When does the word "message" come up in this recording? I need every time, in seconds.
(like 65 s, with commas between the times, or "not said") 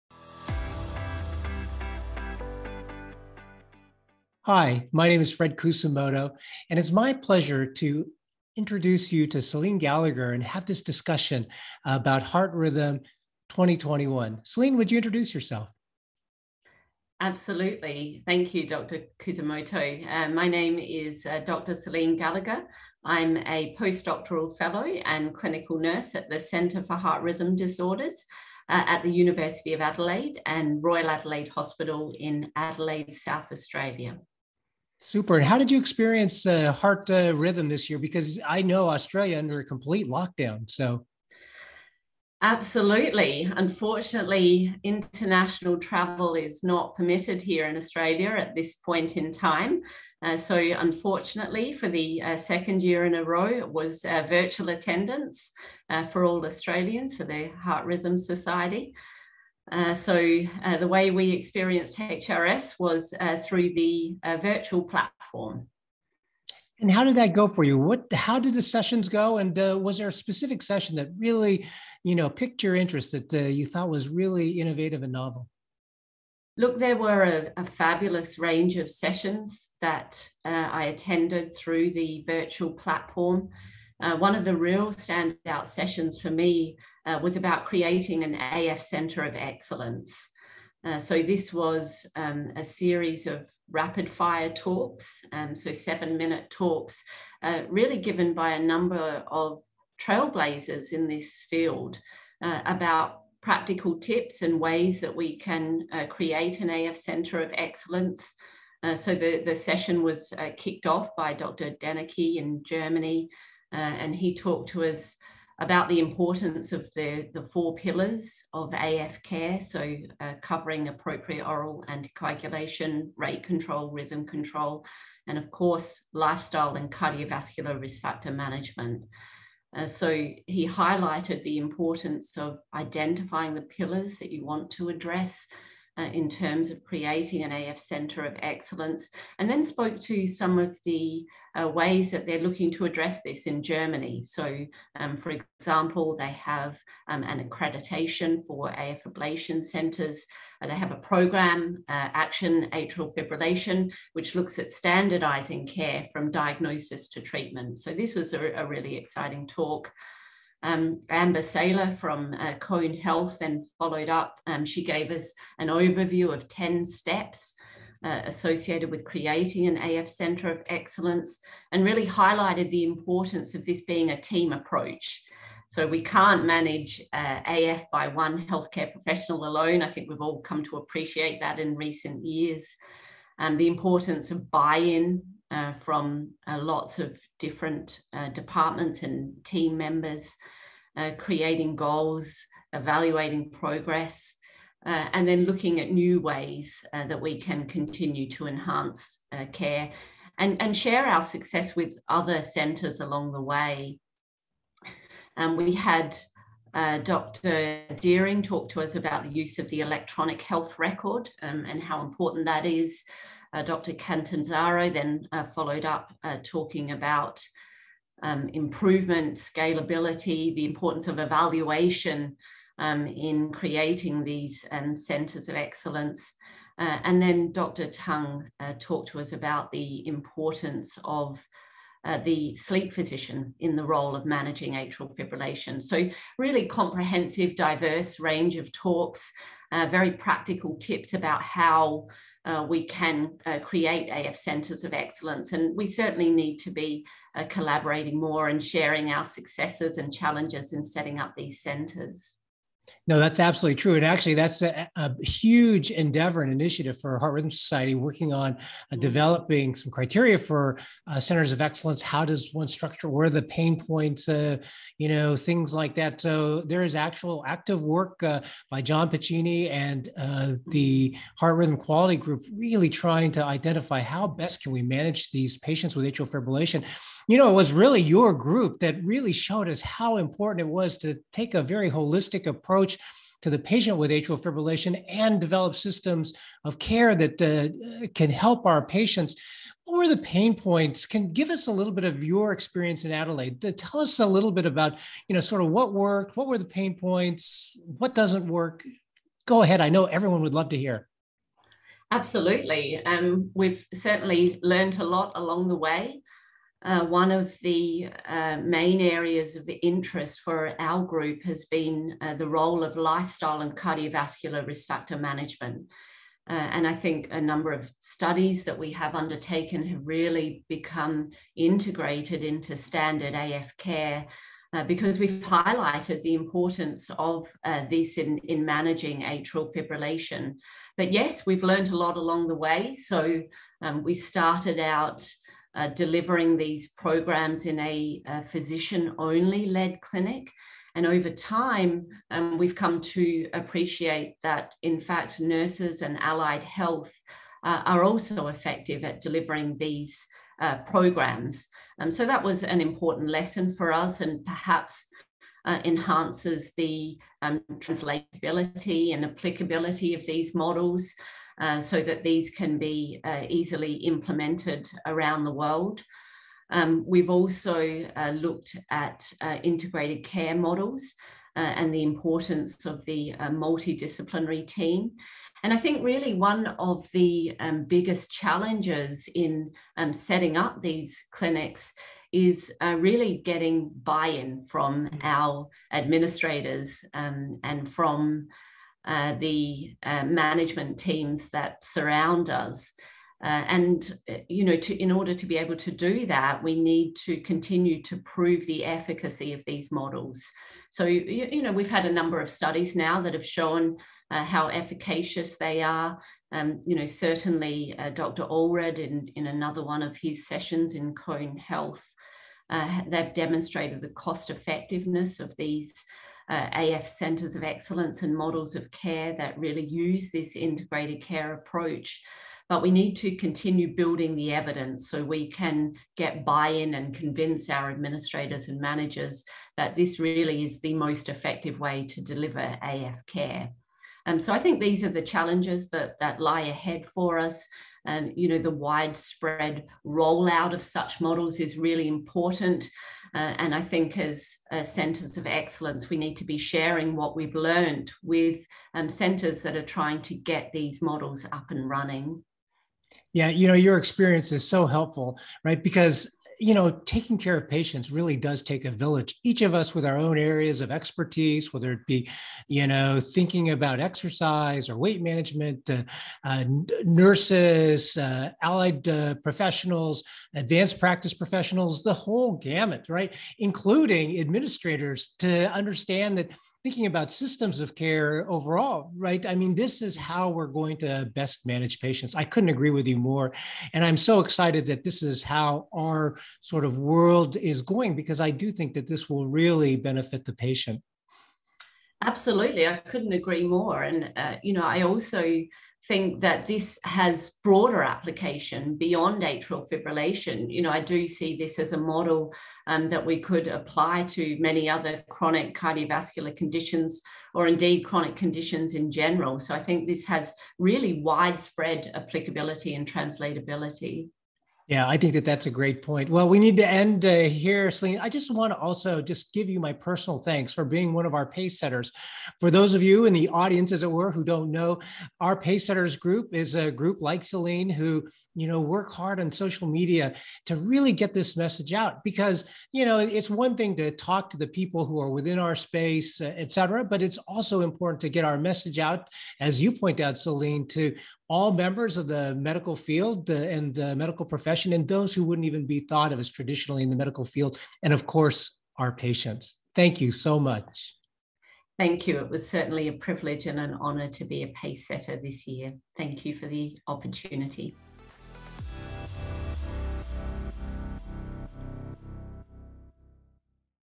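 531 s, 538 s.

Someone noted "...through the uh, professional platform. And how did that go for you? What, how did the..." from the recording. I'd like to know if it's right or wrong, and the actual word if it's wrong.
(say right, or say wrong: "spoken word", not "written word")
wrong: "virtual", not "professional".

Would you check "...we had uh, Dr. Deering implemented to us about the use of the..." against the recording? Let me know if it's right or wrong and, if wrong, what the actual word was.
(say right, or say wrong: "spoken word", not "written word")
wrong: "talked", not "implemented".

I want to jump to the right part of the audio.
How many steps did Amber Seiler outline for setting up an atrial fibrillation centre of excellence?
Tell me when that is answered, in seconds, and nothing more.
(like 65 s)
166 s.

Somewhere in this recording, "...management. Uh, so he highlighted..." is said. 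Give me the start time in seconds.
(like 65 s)
128 s.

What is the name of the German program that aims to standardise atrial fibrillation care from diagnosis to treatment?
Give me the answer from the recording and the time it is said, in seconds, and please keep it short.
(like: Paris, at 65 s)
Action Atrial Fibrillation, at 152 s.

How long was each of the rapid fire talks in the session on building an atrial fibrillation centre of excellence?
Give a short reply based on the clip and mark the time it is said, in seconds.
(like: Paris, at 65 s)
7 minutes, at 95 s.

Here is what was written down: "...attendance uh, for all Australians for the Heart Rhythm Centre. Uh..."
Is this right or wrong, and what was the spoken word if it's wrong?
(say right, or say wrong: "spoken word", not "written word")
wrong: "Society", not "Centre".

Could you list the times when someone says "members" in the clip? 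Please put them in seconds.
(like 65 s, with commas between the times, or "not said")
189 s, 541 s.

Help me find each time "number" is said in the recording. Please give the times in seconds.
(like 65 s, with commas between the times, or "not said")
98 s, 317 s, 402 s.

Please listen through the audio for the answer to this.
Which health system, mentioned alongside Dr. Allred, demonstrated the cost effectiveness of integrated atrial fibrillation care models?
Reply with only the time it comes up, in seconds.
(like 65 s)
411 s.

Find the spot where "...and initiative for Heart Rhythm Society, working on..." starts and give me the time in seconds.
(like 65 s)
256 s.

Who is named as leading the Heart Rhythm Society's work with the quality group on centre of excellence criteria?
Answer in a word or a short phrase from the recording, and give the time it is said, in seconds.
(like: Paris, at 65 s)
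John Piccini, at 268 s.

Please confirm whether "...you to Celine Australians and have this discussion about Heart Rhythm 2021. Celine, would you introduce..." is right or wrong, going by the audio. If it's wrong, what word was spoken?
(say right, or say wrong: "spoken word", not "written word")
wrong: "Gallagher", not "Australians".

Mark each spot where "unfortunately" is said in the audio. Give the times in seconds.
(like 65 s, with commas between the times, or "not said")
43 s, 50 s.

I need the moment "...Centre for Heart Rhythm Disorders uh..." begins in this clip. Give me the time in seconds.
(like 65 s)
26 s.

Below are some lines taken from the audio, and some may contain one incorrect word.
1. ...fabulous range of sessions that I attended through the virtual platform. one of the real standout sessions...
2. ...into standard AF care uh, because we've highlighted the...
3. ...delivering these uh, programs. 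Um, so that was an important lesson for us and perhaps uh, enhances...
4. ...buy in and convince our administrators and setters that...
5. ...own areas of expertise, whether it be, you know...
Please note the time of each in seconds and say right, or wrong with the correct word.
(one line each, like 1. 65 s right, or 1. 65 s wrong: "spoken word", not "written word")
1. 77 s right
2. 322 s right
3. 349 s right
4. 426 s wrong: "managers", not "setters"
5. 460 s right.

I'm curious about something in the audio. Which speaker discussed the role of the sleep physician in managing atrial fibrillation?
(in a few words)
Dr. Tung.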